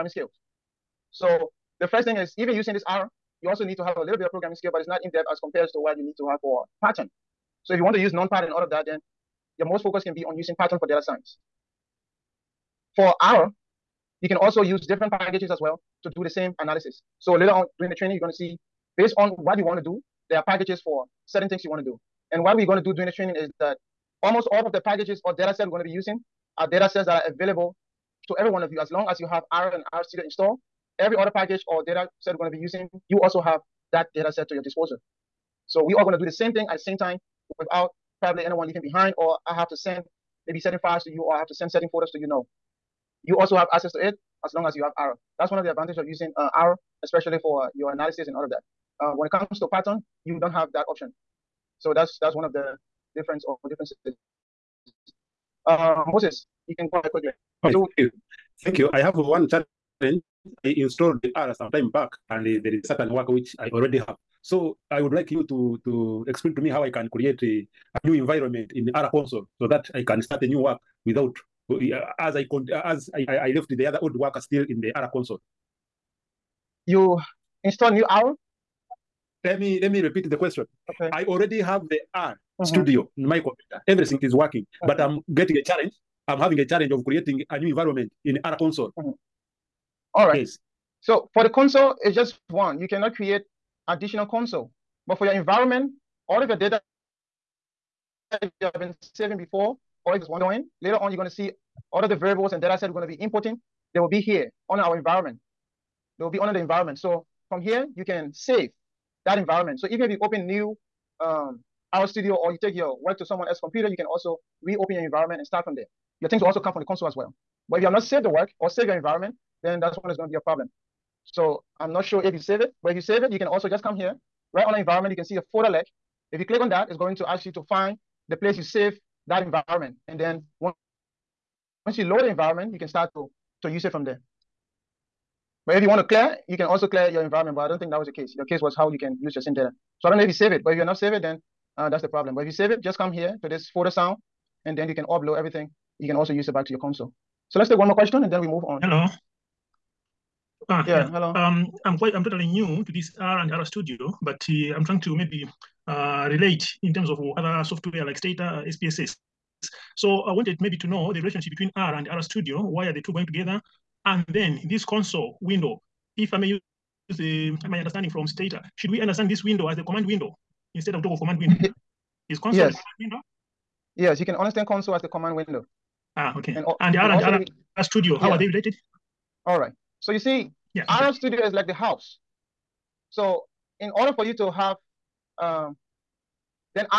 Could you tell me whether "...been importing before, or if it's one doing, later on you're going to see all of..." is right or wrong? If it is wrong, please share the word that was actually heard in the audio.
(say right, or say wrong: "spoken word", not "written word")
wrong: "saving", not "importing".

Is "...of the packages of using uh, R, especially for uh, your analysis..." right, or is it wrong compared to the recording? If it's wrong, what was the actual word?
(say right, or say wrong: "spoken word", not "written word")
wrong: "advantages", not "packages".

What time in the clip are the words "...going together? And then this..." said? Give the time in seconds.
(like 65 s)
163 s.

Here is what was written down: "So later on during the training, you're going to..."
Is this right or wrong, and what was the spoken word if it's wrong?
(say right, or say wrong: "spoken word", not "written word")
right.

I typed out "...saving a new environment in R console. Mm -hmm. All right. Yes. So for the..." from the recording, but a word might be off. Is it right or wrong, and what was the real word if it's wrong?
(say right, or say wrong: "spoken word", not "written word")
wrong: "creating", not "saving".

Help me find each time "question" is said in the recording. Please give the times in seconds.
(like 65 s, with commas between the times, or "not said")
80 s, 147 s.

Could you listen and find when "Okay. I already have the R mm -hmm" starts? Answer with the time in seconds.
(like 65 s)
80 s.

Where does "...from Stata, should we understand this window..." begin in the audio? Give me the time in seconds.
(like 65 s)
168 s.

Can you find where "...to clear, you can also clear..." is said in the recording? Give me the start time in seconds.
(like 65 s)
135 s.